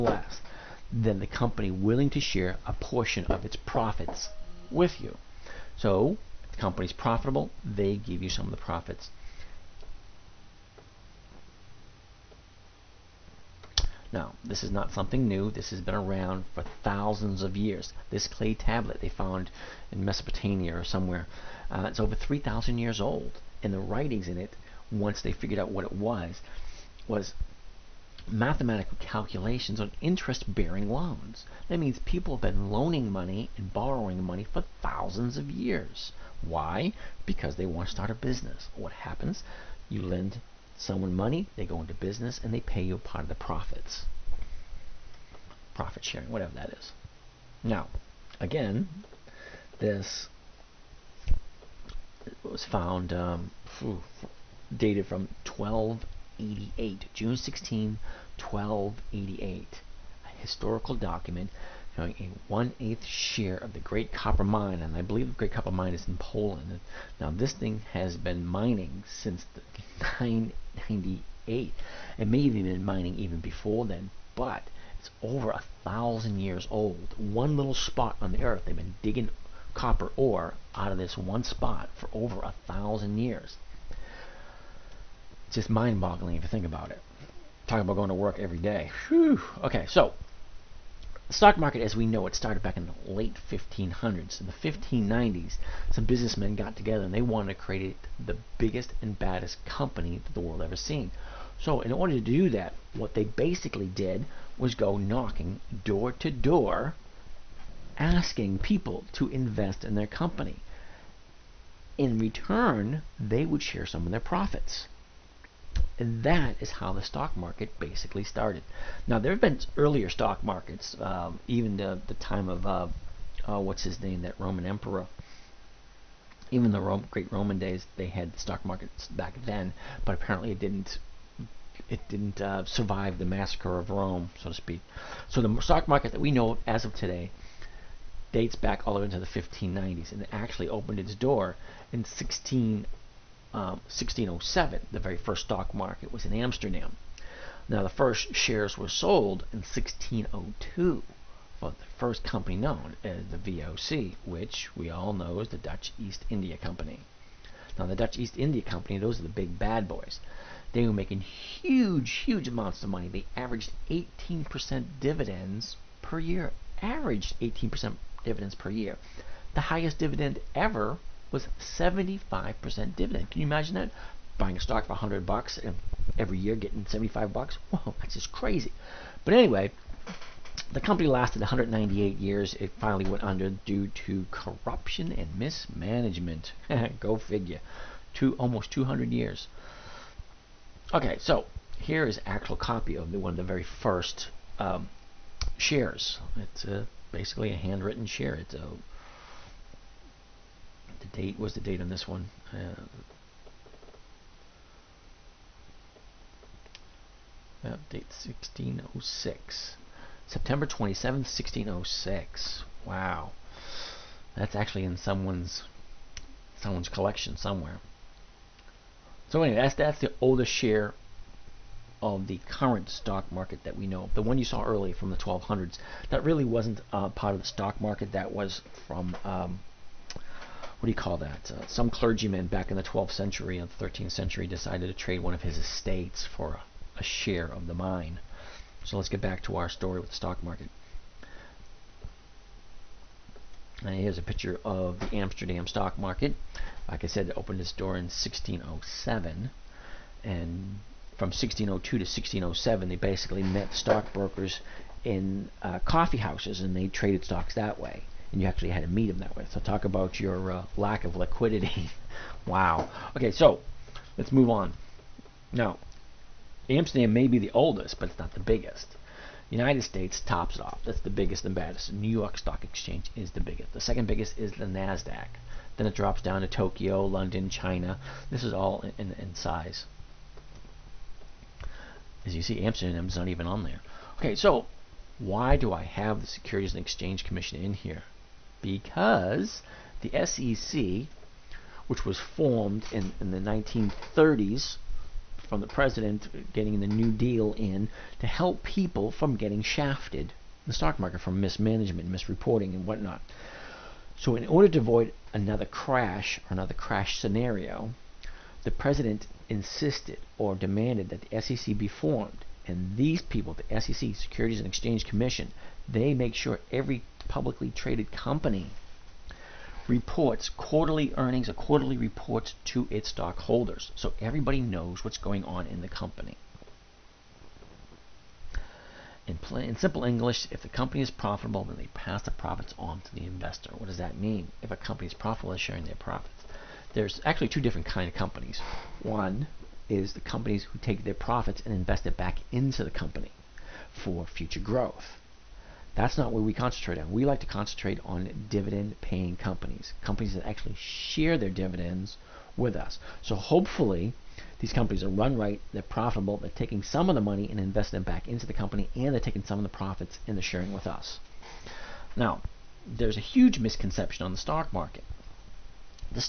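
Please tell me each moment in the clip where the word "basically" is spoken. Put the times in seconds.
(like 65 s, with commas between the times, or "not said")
103 s, 117 s, 197 s, 252 s.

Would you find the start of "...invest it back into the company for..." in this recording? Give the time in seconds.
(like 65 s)
341 s.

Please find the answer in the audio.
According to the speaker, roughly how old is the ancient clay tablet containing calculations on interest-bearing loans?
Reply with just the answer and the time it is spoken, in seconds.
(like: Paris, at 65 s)
over 3,000 years, at 21 s.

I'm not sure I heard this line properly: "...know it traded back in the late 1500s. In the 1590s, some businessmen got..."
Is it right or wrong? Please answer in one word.
wrong.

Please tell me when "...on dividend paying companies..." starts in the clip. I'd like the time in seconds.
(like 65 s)
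348 s.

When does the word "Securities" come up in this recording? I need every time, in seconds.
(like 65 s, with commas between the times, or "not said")
286 s, 314 s.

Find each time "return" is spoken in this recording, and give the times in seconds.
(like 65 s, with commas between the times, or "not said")
112 s.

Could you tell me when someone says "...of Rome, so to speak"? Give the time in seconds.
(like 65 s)
133 s.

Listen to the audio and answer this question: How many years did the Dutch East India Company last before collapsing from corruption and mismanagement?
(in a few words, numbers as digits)
198 years.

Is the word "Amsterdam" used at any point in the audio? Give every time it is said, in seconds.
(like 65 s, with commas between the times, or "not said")
146 s, 245 s, 266 s, 282 s.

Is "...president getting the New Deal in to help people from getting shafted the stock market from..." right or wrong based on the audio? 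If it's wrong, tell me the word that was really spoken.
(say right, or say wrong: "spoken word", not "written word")
right.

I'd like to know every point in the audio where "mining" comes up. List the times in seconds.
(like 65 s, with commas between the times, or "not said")
68 s, 72 s.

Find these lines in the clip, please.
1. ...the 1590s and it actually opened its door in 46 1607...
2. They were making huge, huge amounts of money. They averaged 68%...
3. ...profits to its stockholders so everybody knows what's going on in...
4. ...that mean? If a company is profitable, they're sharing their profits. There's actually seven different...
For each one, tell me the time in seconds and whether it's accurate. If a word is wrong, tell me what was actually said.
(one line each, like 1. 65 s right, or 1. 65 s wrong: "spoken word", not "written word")
1. 139 s wrong: "16", not "46"
2. 160 s wrong: "18", not "68"
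3. 321 s wrong: "reports", not "profits"
4. 333 s wrong: "two", not "seven".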